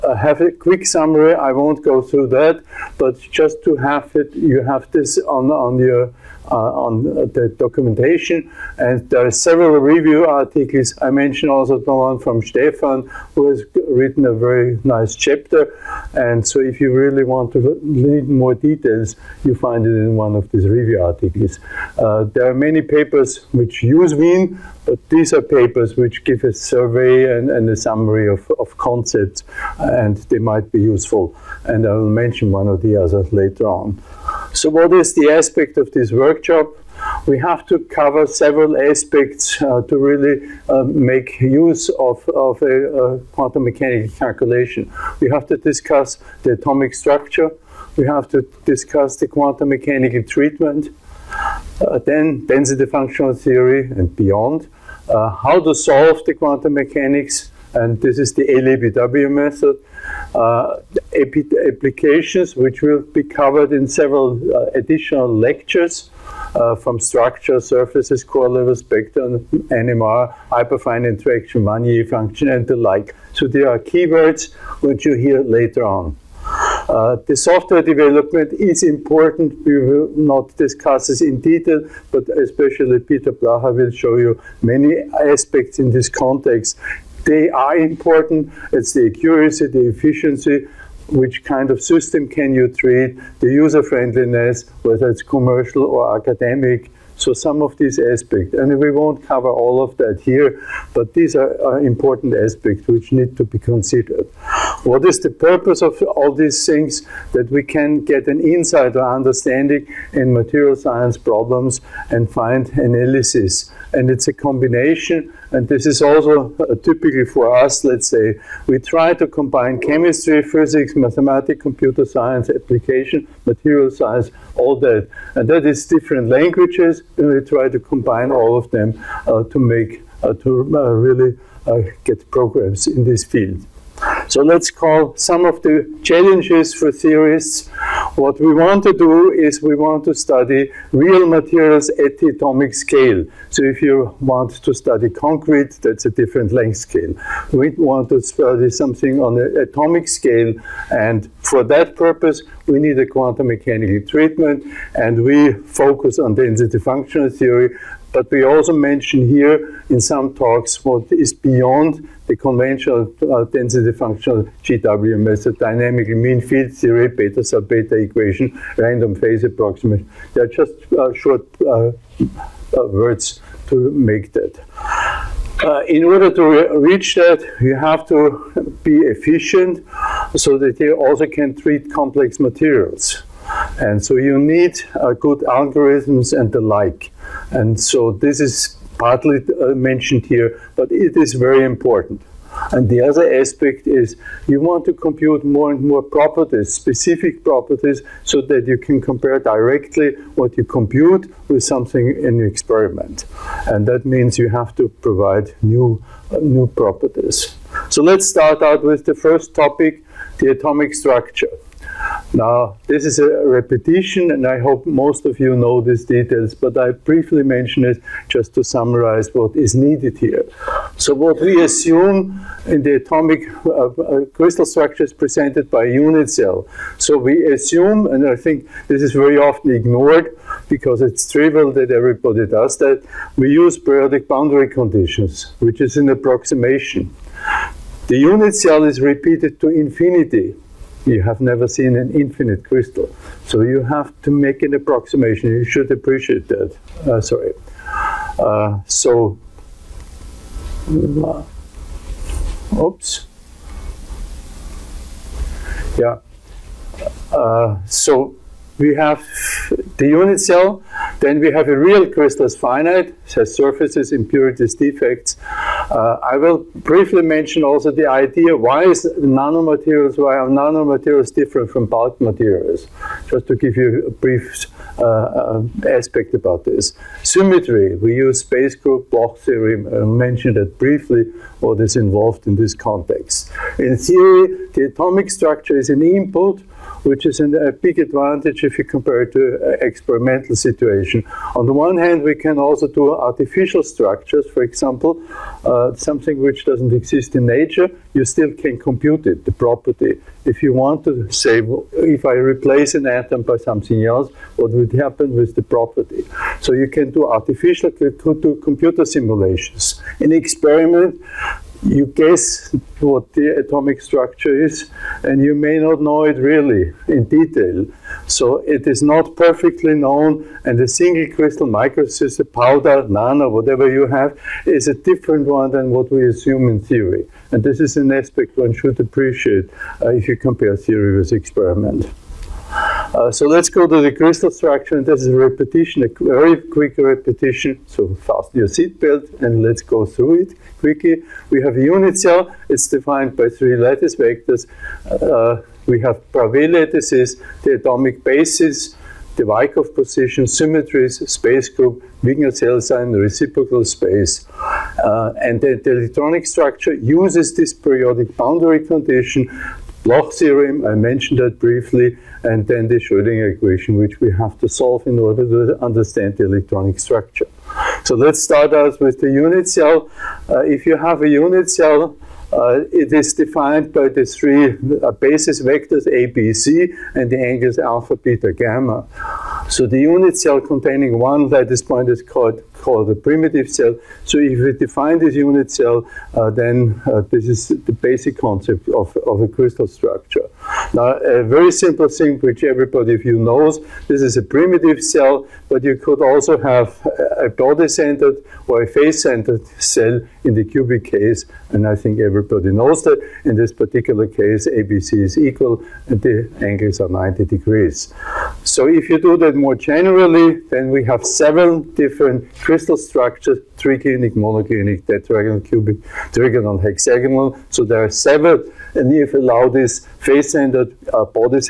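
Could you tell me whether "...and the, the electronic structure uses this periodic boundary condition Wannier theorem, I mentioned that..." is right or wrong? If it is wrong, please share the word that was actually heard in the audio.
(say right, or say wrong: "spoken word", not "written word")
wrong: "Bloch", not "Wannier".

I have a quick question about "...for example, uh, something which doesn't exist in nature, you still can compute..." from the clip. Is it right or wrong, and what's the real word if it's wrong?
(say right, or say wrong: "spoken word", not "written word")
right.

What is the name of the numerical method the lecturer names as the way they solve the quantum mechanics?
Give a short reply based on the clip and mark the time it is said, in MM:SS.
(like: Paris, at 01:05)
LAPW method, at 00:58.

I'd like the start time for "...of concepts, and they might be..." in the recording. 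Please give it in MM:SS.
00:28.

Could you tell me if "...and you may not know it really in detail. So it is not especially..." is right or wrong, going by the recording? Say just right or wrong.
wrong.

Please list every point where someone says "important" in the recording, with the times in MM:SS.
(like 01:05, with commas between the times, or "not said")
01:18, 01:27, 01:41, 03:11.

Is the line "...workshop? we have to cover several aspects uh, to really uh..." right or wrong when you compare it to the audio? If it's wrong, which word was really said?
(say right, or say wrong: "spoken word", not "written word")
right.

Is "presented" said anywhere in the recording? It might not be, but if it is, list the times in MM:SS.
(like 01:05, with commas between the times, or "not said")
03:45.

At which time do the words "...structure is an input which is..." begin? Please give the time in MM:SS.
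04:45.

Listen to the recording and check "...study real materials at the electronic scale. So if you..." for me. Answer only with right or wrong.
wrong.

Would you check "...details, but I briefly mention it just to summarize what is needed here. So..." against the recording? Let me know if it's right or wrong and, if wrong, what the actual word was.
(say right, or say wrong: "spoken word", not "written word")
right.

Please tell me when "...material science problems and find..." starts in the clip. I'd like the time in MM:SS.
01:50.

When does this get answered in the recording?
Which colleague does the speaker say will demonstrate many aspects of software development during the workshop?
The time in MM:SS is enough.
01:22.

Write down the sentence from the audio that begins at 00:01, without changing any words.
I won't go through that, but just to have it, you have this on, on your uh, on the documentation.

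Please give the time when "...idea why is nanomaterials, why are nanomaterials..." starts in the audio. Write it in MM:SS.
04:28.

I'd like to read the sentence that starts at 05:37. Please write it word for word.
So fasten your seatbelt, and let's go through it quickly.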